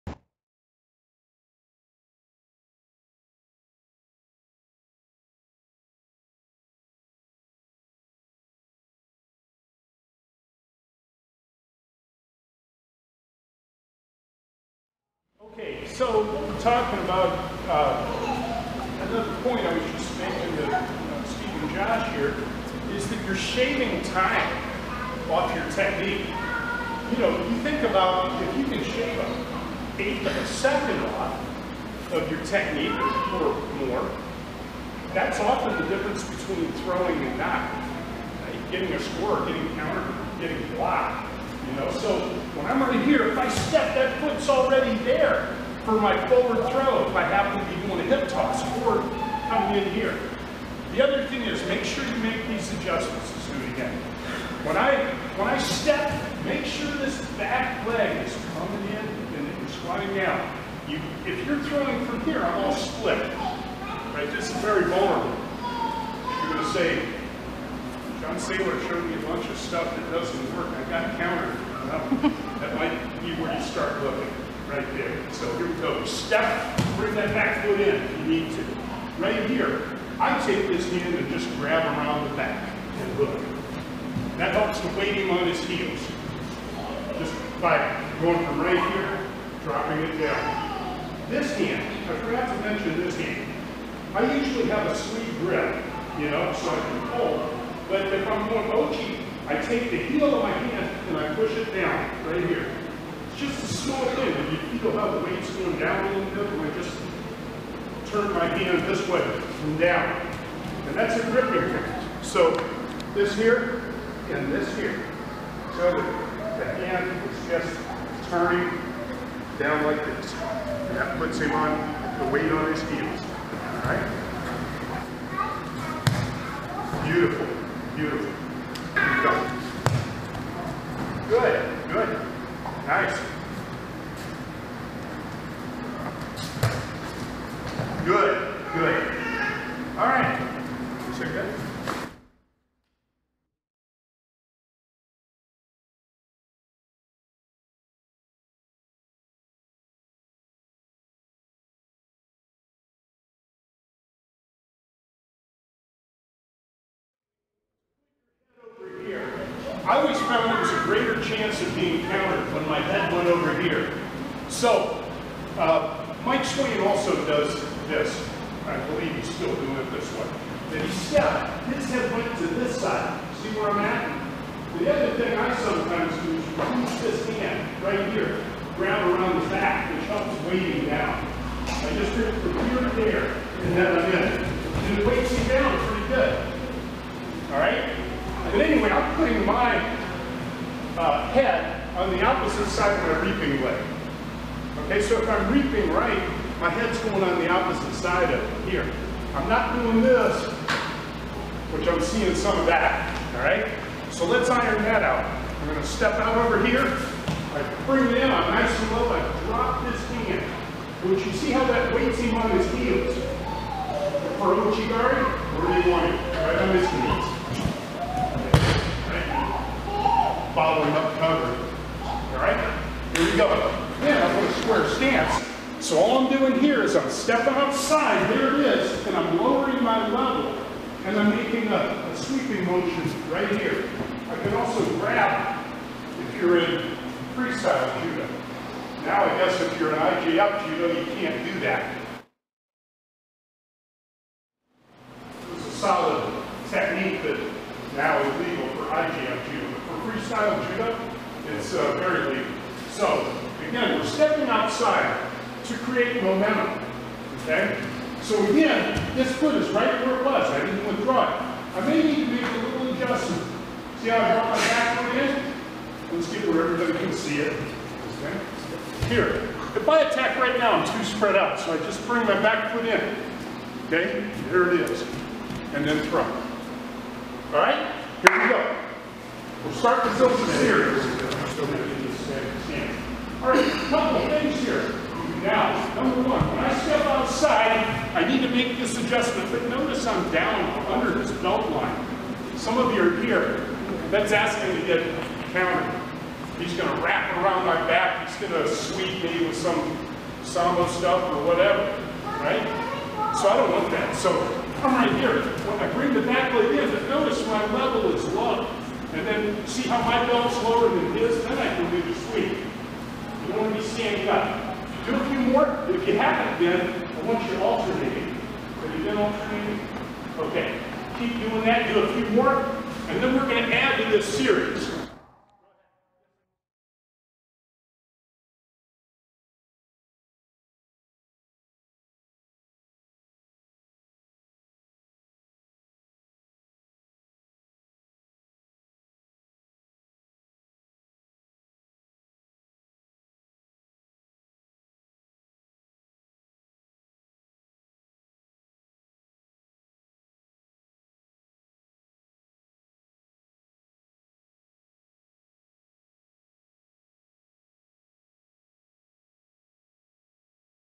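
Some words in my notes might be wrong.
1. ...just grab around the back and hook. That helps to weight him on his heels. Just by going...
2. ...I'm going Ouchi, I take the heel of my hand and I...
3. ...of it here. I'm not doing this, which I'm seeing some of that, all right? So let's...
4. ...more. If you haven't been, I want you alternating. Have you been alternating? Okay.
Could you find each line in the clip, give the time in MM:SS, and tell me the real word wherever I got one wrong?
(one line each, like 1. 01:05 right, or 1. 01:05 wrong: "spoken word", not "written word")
1. 01:21 right
2. 01:38 right
3. 03:18 right
4. 05:15 right.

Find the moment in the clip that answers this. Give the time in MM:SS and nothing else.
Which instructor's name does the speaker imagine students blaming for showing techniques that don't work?
01:08.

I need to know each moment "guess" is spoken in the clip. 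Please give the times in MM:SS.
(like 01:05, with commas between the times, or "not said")
03:59.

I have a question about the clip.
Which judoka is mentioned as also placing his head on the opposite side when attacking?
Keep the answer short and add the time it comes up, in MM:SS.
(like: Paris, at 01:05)
Mike Swain, at 02:46.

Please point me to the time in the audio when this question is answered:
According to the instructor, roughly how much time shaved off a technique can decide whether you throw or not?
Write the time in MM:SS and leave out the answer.
00:29.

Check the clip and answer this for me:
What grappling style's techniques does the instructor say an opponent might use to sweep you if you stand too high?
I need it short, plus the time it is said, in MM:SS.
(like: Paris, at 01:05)
sambo, at 05:00.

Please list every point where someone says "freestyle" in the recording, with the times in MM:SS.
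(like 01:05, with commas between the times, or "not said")
03:57, 04:10.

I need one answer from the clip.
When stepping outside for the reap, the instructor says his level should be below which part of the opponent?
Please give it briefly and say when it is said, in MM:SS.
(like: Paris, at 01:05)
belt line, at 04:51.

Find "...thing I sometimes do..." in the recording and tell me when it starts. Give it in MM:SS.
02:55.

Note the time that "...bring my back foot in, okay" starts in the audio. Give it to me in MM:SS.
04:32.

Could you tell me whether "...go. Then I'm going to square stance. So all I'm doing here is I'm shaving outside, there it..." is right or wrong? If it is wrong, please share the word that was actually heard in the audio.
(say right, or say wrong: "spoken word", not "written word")
wrong: "stepping", not "shaving".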